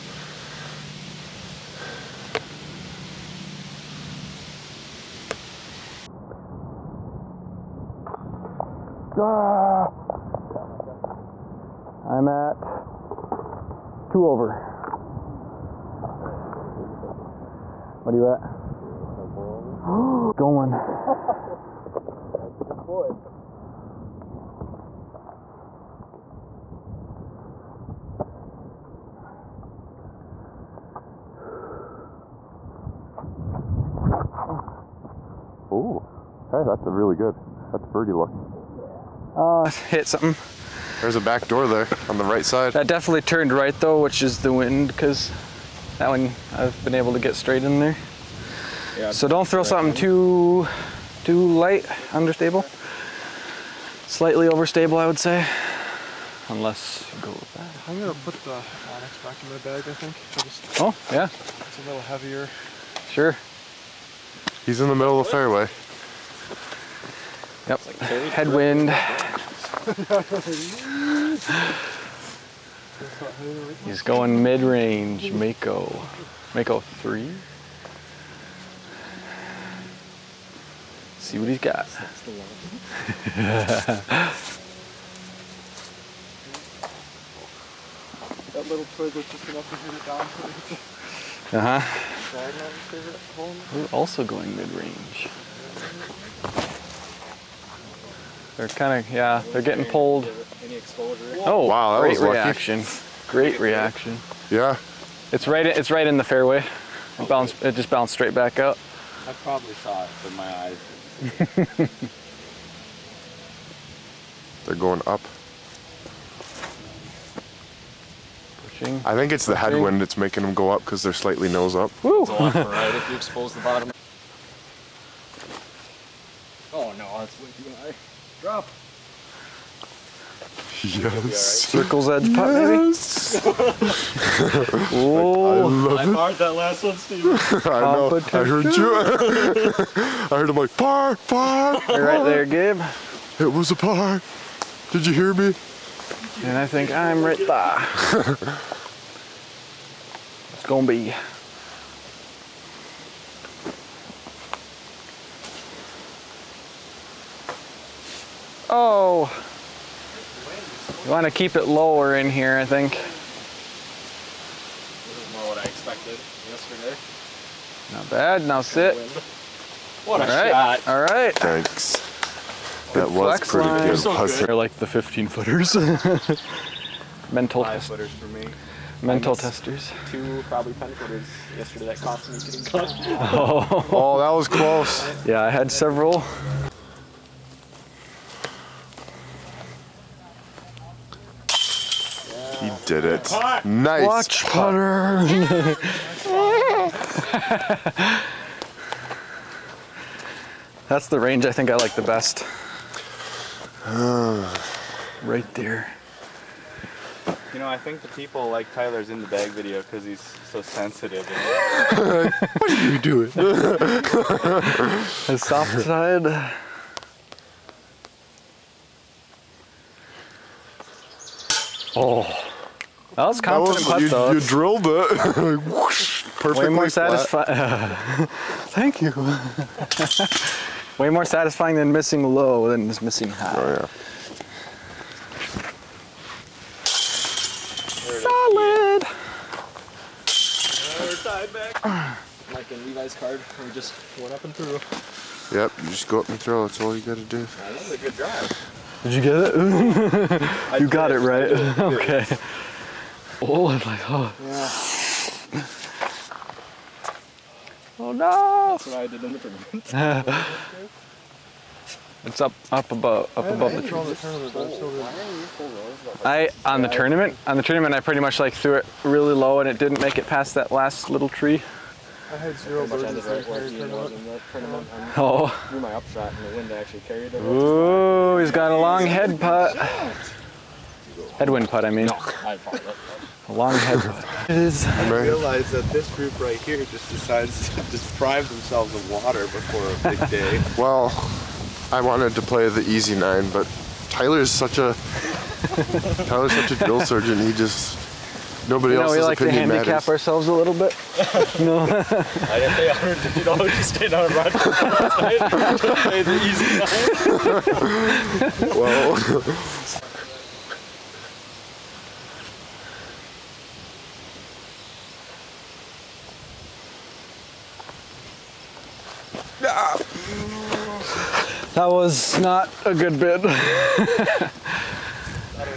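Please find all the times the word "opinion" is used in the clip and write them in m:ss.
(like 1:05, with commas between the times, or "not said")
4:59.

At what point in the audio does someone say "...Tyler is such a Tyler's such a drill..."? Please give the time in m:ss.
4:54.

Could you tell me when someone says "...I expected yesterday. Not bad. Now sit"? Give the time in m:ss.
2:45.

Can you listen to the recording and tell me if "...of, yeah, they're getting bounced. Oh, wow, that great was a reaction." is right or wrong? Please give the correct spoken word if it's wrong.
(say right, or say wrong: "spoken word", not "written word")
wrong: "pulled", not "bounced".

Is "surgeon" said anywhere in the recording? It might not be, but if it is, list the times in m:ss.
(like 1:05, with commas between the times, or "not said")
4:57.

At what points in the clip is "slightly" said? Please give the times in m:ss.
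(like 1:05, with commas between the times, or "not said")
0:54, 2:01.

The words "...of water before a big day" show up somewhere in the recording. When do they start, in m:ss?
4:48.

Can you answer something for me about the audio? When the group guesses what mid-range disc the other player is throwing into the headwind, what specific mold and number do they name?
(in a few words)
Mako 3.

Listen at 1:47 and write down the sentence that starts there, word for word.
It, bounced, it just bounced straight back up.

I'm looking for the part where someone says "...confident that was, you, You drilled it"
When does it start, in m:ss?
3:43.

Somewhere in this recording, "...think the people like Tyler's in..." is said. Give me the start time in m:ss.
3:27.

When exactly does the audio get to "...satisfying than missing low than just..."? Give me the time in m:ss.
3:51.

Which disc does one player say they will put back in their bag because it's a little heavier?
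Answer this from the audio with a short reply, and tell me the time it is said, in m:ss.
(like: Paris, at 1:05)
Onyx, at 0:58.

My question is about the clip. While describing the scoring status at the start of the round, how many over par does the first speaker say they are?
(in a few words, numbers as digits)
2.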